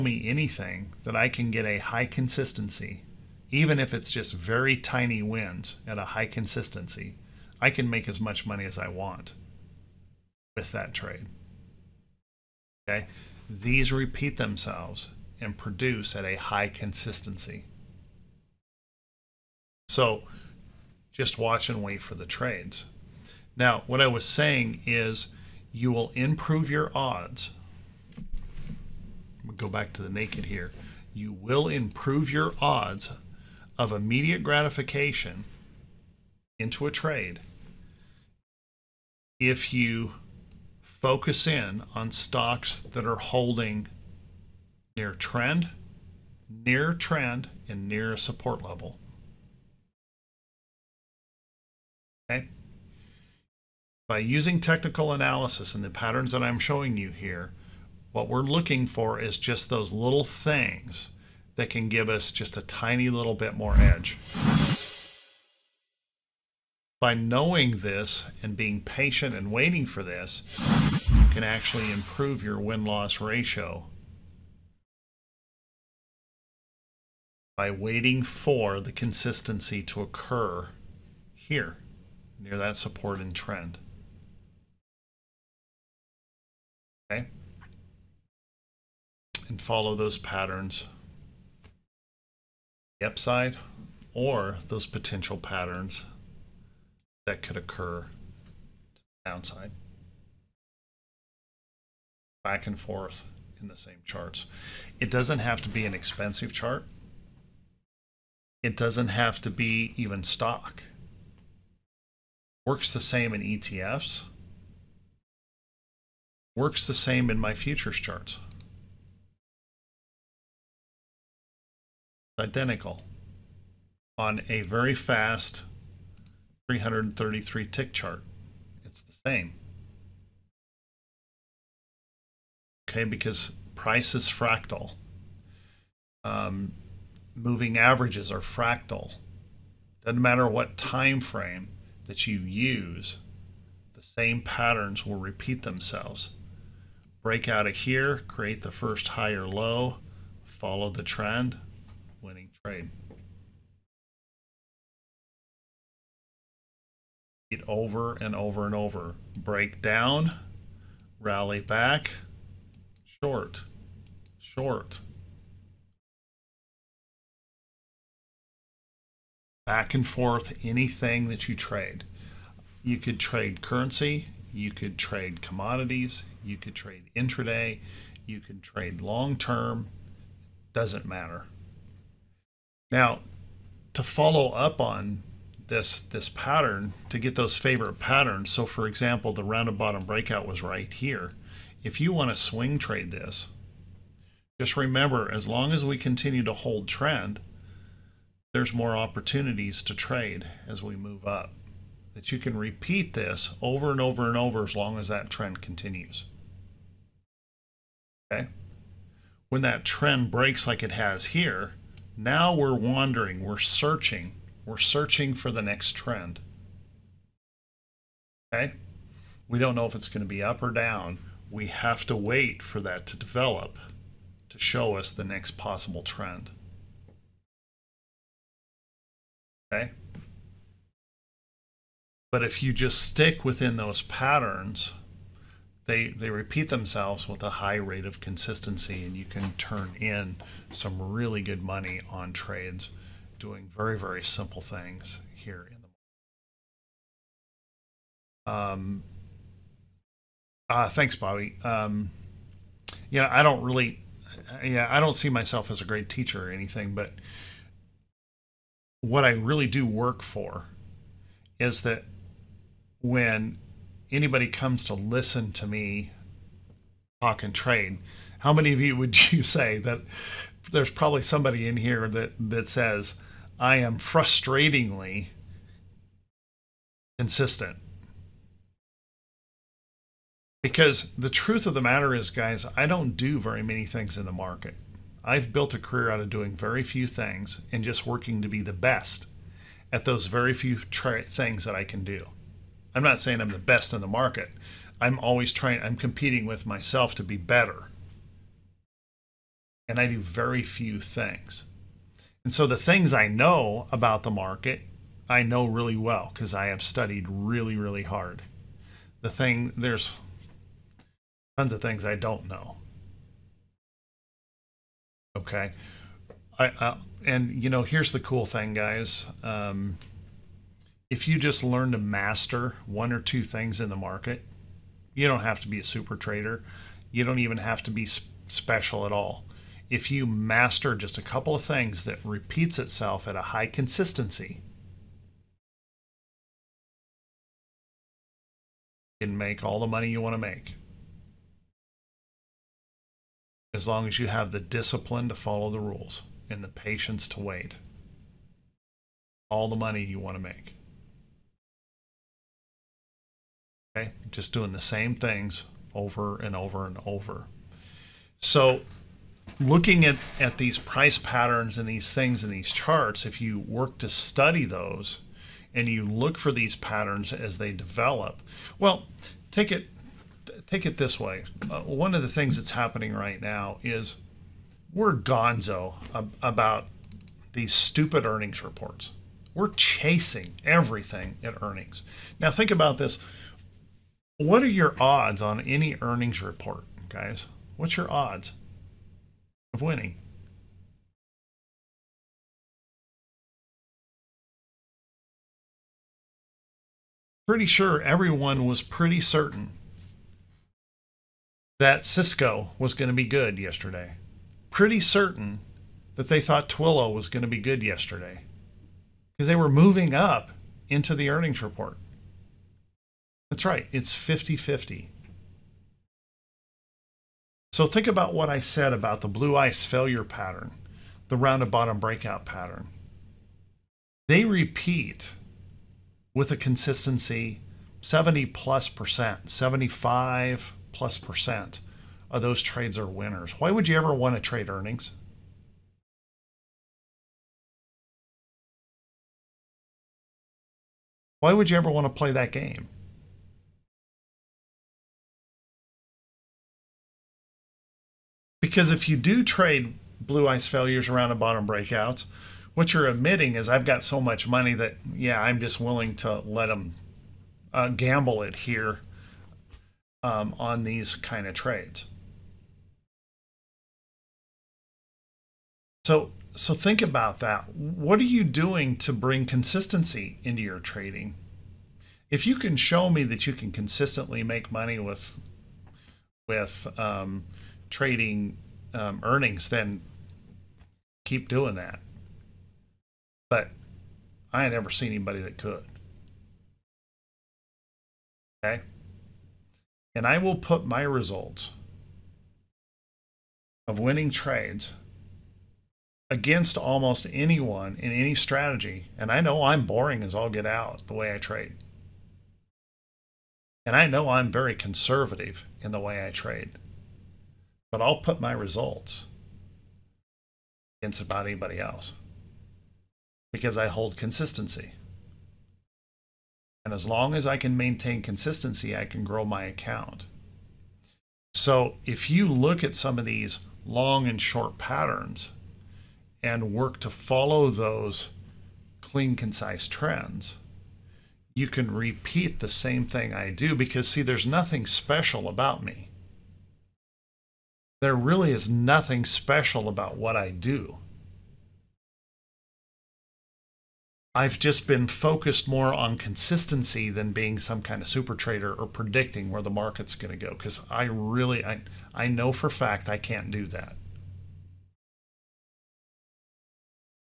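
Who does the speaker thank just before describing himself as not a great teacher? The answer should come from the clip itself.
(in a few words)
Bobby.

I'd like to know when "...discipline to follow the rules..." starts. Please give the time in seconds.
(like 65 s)
344 s.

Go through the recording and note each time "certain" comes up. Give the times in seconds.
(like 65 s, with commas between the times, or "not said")
399 s, 404 s.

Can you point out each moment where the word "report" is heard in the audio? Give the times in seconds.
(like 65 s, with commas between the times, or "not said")
378 s, 386 s, 411 s.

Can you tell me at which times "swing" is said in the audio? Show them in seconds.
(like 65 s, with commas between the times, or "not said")
192 s.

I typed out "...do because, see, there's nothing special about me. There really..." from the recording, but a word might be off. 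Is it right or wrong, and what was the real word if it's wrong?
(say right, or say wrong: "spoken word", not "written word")
right.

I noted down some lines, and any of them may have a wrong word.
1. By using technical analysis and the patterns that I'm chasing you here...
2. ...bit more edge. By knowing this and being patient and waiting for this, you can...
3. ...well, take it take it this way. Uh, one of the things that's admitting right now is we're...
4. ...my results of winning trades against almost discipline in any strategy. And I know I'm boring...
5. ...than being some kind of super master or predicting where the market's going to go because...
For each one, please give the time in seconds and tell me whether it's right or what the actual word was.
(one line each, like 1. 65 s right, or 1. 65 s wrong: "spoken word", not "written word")
1. 54 s wrong: "showing", not "chasing"
2. 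63 s right
3. 368 s wrong: "happening", not "admitting"
4. 490 s wrong: "anyone", not "discipline"
5. 547 s wrong: "trader", not "master".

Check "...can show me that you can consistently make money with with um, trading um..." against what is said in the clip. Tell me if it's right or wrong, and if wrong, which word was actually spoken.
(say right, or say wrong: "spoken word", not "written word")
right.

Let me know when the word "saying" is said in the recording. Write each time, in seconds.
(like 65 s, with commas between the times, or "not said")
24 s, 293 s.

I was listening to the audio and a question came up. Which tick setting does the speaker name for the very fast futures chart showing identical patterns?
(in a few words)
333 tick.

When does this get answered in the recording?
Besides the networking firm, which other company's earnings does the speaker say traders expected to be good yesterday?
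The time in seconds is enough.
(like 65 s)
406 s.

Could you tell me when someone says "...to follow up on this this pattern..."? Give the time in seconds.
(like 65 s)
183 s.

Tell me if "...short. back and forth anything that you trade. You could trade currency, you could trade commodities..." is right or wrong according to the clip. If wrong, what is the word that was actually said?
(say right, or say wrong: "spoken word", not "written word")
right.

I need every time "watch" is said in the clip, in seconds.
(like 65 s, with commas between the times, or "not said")
21 s.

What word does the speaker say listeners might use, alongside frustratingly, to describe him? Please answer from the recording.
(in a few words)
consistent.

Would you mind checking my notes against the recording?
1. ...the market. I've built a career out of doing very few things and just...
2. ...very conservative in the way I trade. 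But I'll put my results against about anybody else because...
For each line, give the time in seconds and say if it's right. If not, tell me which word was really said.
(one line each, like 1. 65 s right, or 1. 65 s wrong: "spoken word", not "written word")
1. 284 s right
2. 504 s right.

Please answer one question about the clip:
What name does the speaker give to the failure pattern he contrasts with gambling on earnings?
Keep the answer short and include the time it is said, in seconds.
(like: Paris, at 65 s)
blue ice failure, at 419 s.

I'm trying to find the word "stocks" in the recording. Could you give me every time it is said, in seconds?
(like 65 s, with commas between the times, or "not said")
42 s, 110 s.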